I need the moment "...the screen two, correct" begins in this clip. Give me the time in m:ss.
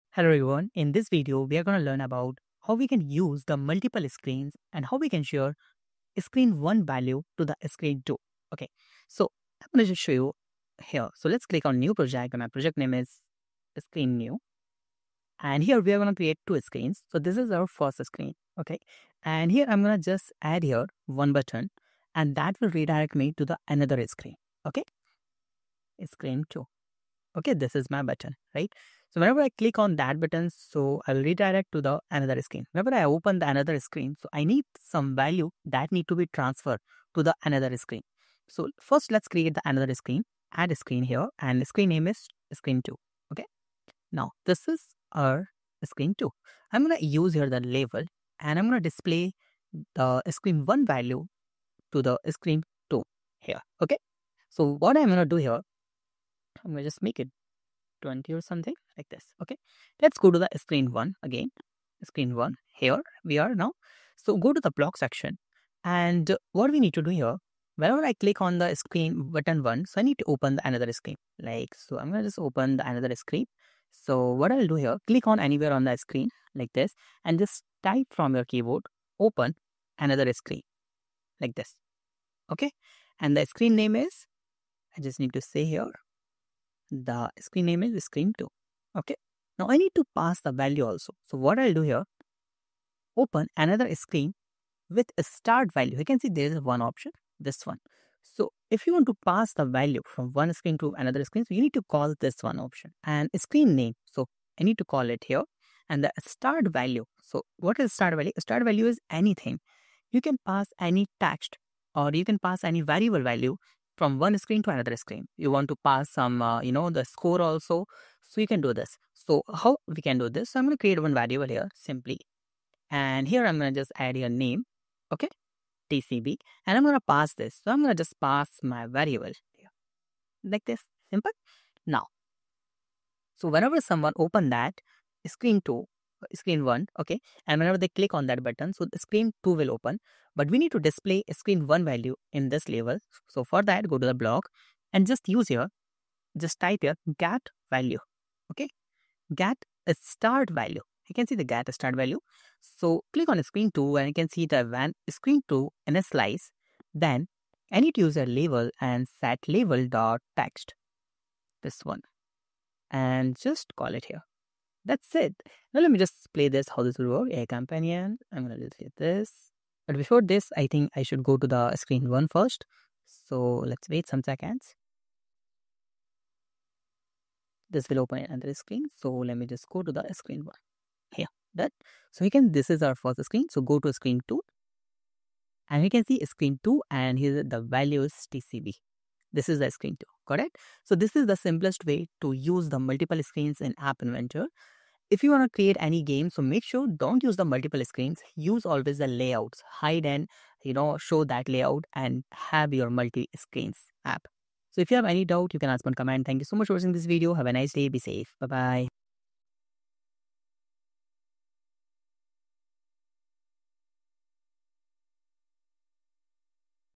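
3:09.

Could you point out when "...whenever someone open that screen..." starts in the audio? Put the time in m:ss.
2:13.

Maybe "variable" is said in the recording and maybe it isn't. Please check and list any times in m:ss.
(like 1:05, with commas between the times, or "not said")
1:52, 2:01, 2:08.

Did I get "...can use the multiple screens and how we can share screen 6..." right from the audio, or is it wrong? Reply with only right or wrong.
wrong.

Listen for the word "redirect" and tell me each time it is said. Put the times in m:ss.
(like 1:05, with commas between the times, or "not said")
0:22, 0:31.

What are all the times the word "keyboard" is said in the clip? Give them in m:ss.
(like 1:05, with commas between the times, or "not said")
1:18.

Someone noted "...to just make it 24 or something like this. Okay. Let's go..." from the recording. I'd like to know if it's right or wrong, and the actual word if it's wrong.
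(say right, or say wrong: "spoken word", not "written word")
wrong: "20", not "24".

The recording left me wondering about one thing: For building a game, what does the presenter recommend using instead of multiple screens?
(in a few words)
layouts.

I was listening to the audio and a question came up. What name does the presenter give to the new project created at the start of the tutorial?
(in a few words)
screen new.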